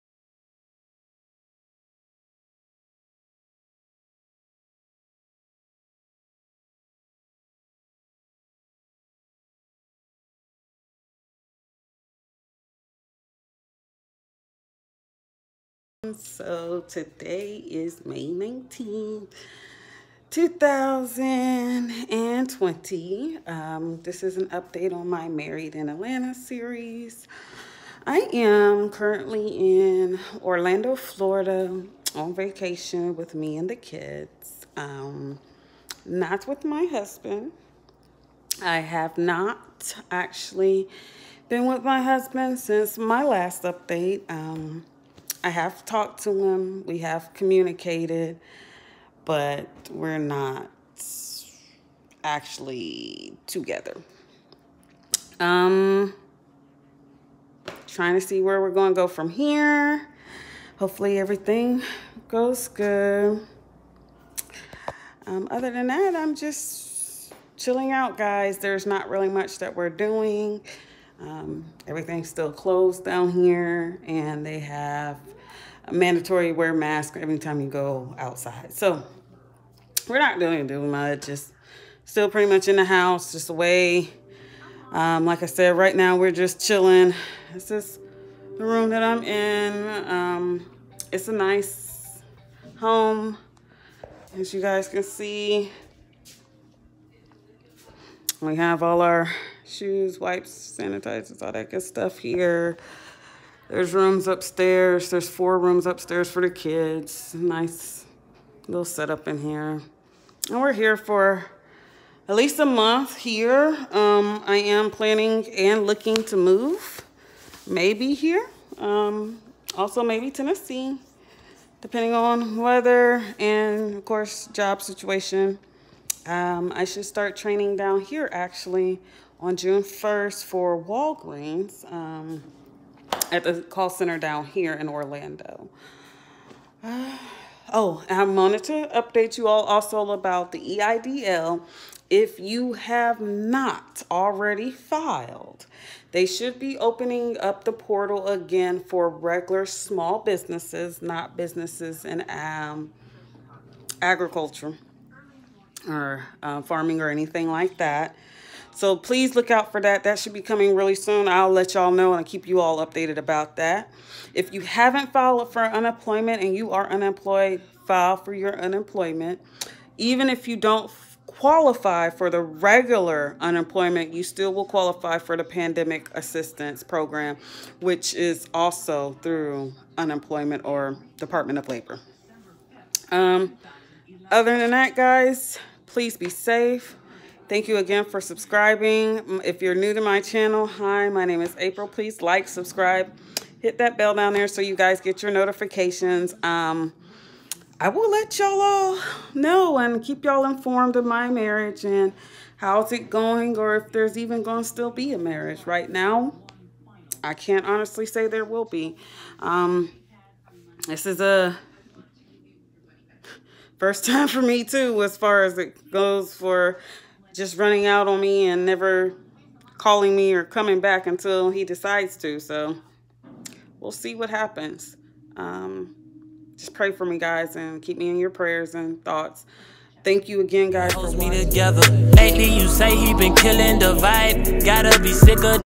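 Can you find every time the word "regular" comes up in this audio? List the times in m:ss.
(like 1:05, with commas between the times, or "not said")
2:29, 2:52.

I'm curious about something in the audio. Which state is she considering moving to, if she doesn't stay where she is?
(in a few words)
Tennessee.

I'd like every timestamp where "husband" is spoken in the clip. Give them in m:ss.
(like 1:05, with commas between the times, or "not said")
0:36, 0:42.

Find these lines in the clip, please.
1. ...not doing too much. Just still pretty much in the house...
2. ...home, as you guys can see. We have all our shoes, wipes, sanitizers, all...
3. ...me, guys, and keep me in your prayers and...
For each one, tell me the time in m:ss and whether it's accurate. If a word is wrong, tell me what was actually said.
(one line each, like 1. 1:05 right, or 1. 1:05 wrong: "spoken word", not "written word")
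1. 1:20 right
2. 1:32 right
3. 3:47 right.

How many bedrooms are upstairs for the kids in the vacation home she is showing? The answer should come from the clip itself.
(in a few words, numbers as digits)
4.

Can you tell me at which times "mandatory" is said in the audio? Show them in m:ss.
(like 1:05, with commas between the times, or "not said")
1:15.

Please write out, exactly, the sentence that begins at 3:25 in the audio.
Right now, I can't honestly say there will be.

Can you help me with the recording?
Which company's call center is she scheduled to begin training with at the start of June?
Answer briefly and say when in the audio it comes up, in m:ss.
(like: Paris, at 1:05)
Walgreens, at 2:10.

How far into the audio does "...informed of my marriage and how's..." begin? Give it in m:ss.
3:20.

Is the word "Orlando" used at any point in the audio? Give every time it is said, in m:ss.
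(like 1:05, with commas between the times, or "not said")
0:30, 2:14.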